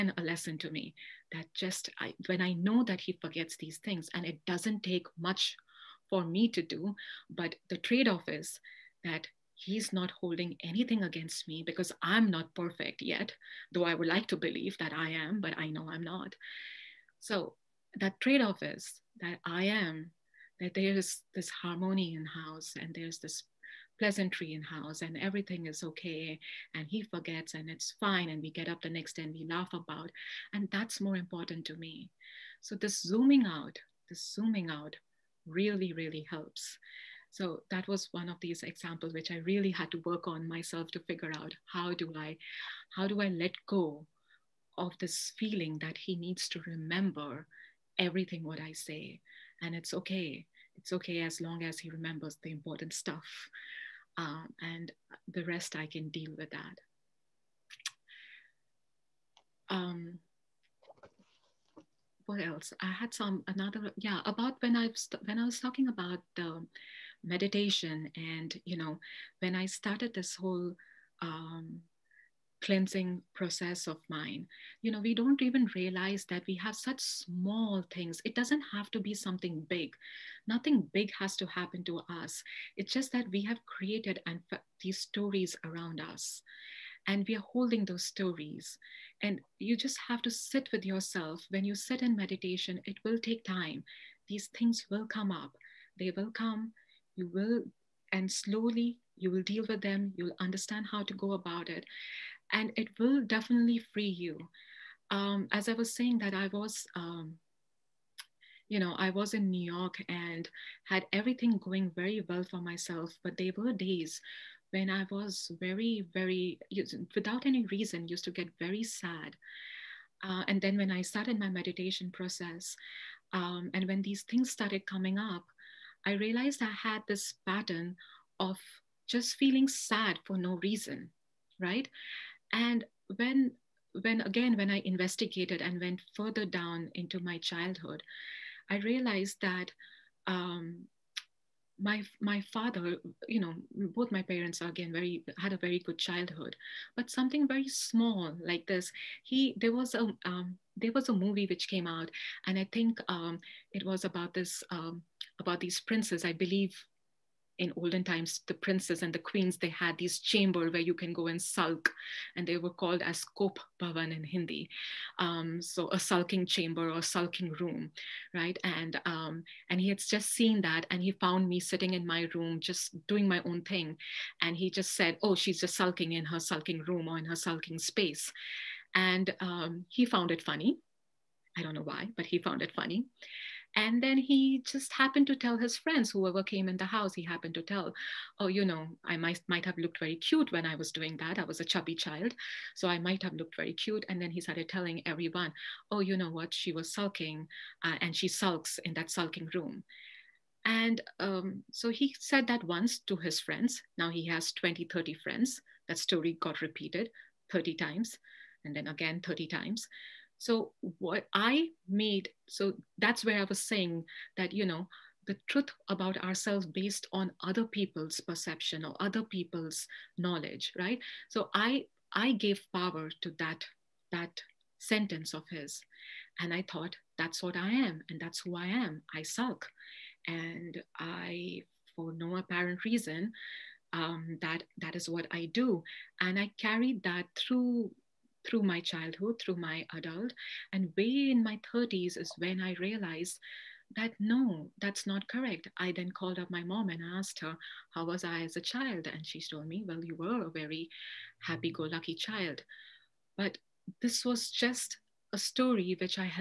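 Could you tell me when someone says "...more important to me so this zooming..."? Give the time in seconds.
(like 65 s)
30 s.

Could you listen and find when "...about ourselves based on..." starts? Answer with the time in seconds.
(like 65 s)
215 s.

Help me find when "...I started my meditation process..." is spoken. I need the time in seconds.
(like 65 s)
120 s.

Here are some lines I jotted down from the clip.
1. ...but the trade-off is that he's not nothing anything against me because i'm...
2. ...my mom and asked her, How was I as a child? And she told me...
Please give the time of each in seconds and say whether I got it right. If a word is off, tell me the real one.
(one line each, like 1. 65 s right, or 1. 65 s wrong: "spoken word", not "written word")
1. 7 s wrong: "holding", not "nothing"
2. 246 s right.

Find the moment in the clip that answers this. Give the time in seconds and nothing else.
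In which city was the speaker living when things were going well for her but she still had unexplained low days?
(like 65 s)
109 s.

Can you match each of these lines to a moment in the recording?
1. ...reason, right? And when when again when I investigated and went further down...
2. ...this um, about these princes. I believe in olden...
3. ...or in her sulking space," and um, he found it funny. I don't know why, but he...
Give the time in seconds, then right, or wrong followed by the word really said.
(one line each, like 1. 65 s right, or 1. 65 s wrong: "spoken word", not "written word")
1. 130 s right
2. 154 s right
3. 177 s right.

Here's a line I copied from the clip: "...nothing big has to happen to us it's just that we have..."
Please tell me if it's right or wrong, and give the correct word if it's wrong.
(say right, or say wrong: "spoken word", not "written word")
right.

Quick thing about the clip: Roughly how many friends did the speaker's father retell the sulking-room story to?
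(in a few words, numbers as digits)
20, 30.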